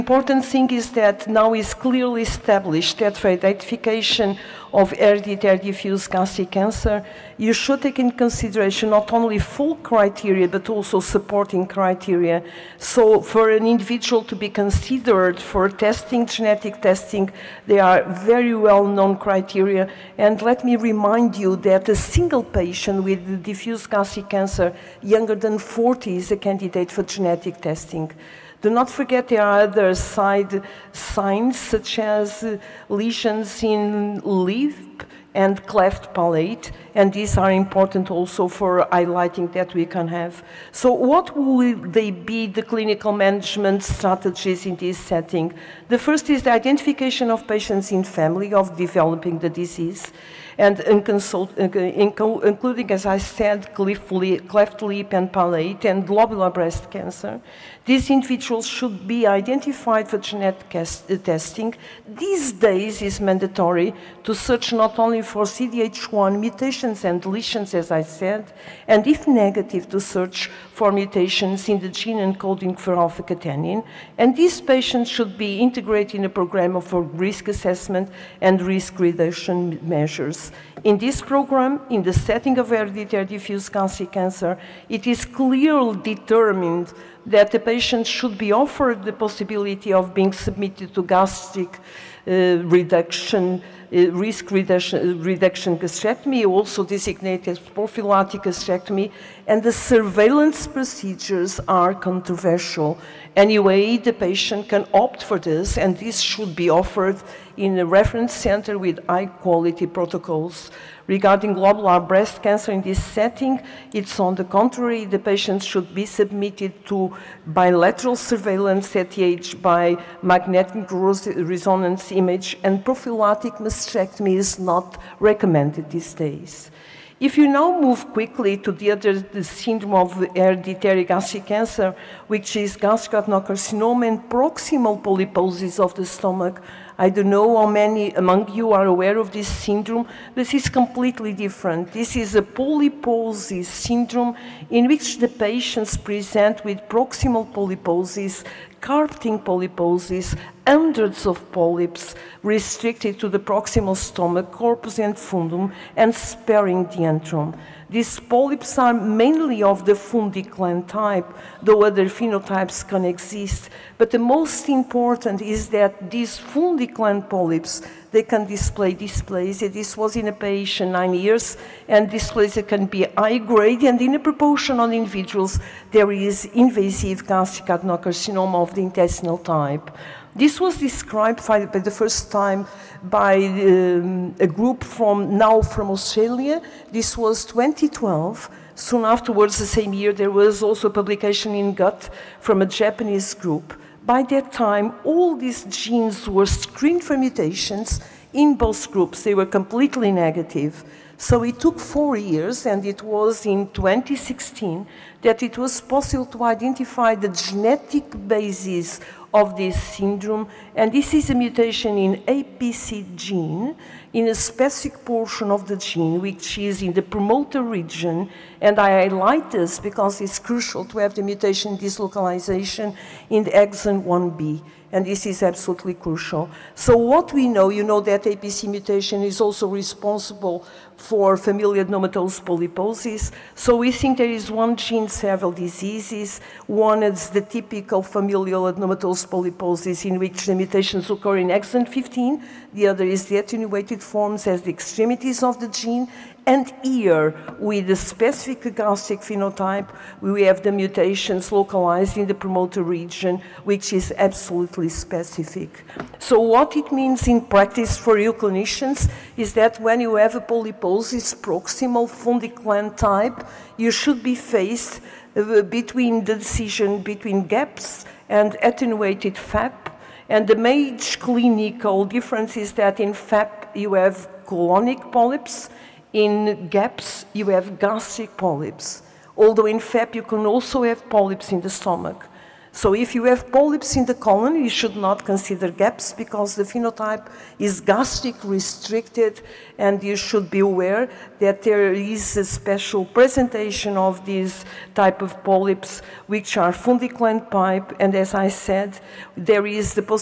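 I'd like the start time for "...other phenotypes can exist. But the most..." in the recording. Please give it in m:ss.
2:41.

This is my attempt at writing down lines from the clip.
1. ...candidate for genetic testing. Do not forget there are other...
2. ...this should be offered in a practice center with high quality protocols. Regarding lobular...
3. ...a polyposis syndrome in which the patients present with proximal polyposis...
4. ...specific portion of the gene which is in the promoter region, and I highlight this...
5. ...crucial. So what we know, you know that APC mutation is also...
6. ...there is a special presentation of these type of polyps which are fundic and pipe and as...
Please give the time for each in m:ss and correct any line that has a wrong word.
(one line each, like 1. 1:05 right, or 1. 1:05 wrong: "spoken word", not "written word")
1. 0:26 right
2. 1:45 wrong: "reference", not "practice"
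3. 2:22 right
4. 3:34 right
5. 3:45 right
6. 4:51 right.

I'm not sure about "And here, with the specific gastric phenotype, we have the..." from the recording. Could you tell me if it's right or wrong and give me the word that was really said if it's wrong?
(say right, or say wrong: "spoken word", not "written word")
right.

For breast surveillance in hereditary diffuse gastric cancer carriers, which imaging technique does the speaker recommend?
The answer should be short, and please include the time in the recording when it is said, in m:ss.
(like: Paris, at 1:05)
magnetic resonance image, at 2:00.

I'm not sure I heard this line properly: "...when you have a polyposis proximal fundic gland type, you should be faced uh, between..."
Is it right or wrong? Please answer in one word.
right.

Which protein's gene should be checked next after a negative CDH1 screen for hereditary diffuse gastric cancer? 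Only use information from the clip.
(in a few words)
alpha catenin.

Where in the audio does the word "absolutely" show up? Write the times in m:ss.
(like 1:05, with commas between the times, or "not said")
3:45, 4:14.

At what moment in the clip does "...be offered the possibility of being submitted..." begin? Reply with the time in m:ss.
1:28.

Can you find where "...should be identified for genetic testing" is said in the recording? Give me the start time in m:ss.
0:58.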